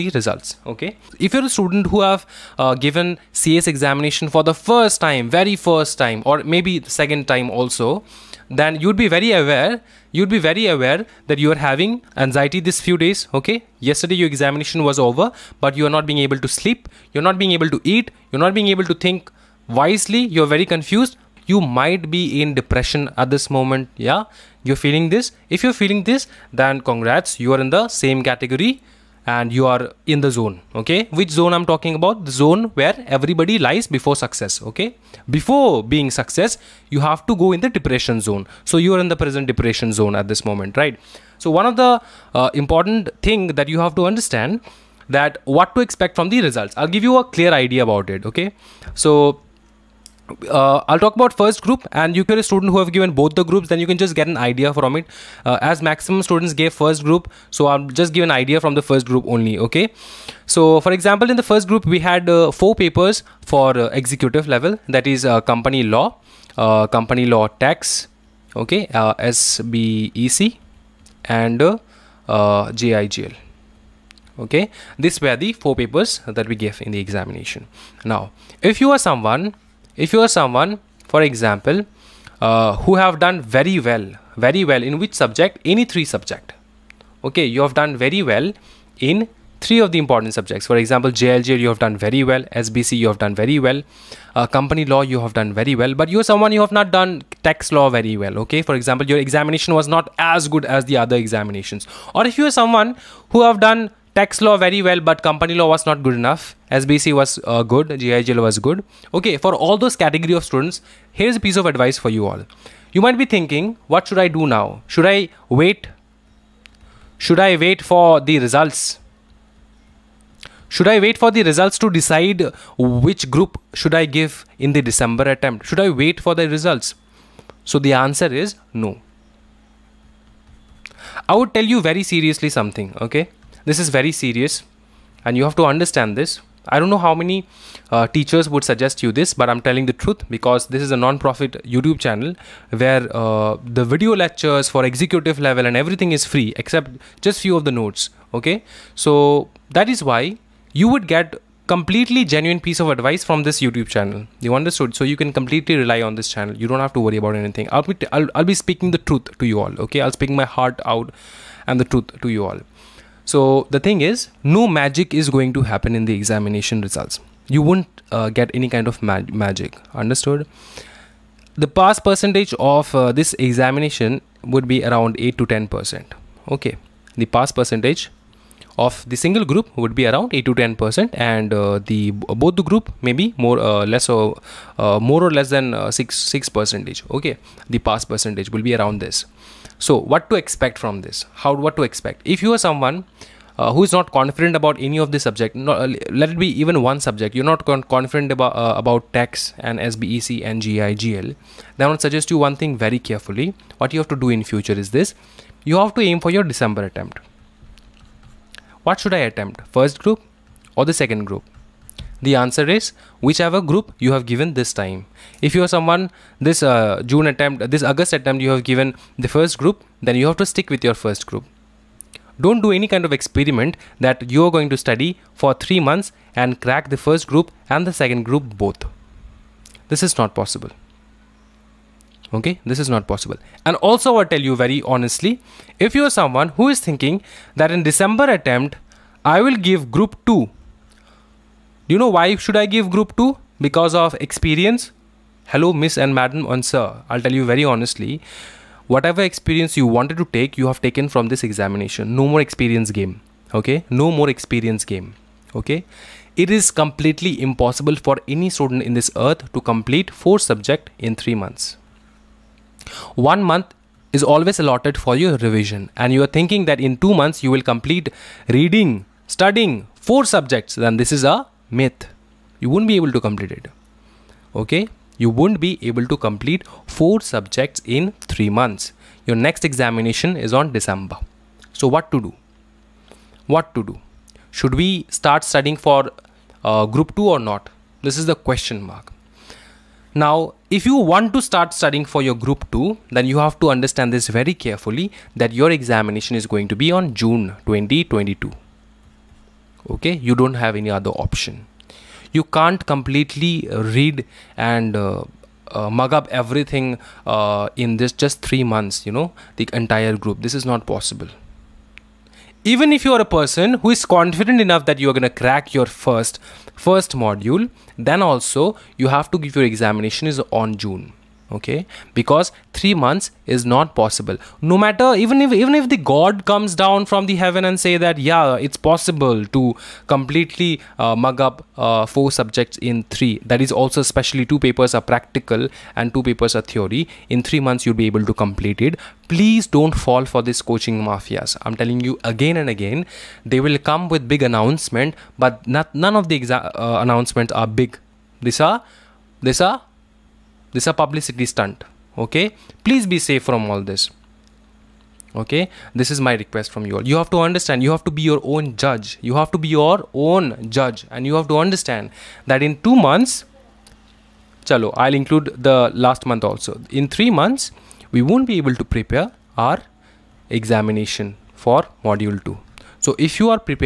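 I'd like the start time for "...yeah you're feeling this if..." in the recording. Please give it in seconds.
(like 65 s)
23 s.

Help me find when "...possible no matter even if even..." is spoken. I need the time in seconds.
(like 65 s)
323 s.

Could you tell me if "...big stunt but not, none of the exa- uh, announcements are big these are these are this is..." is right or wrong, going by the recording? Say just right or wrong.
wrong.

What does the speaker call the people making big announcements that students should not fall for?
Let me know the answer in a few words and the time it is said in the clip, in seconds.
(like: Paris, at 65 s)
coaching mafias, at 340 s.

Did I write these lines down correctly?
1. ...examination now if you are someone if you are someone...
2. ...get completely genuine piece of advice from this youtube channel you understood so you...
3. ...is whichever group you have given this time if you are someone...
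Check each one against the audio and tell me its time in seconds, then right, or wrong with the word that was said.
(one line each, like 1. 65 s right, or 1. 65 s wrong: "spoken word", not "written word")
1. 76 s right
2. 151 s right
3. 212 s right.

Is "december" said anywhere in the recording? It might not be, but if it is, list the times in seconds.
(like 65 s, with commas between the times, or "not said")
124 s, 206 s, 237 s, 280 s.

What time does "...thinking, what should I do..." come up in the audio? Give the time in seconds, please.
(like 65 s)
113 s.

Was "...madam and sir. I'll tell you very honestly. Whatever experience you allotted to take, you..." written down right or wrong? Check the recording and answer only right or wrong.
wrong.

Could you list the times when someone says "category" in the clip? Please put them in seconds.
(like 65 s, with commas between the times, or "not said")
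28 s, 110 s.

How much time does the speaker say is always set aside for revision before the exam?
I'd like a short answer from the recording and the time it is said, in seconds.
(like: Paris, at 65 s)
1 month, at 263 s.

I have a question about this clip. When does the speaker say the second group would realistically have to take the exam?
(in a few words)
June 2022.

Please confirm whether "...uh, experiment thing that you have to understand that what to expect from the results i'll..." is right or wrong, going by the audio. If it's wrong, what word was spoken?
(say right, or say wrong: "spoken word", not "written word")
wrong: "important", not "experiment".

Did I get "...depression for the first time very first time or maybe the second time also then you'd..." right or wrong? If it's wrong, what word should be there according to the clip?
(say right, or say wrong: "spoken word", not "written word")
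wrong: "examination", not "depression".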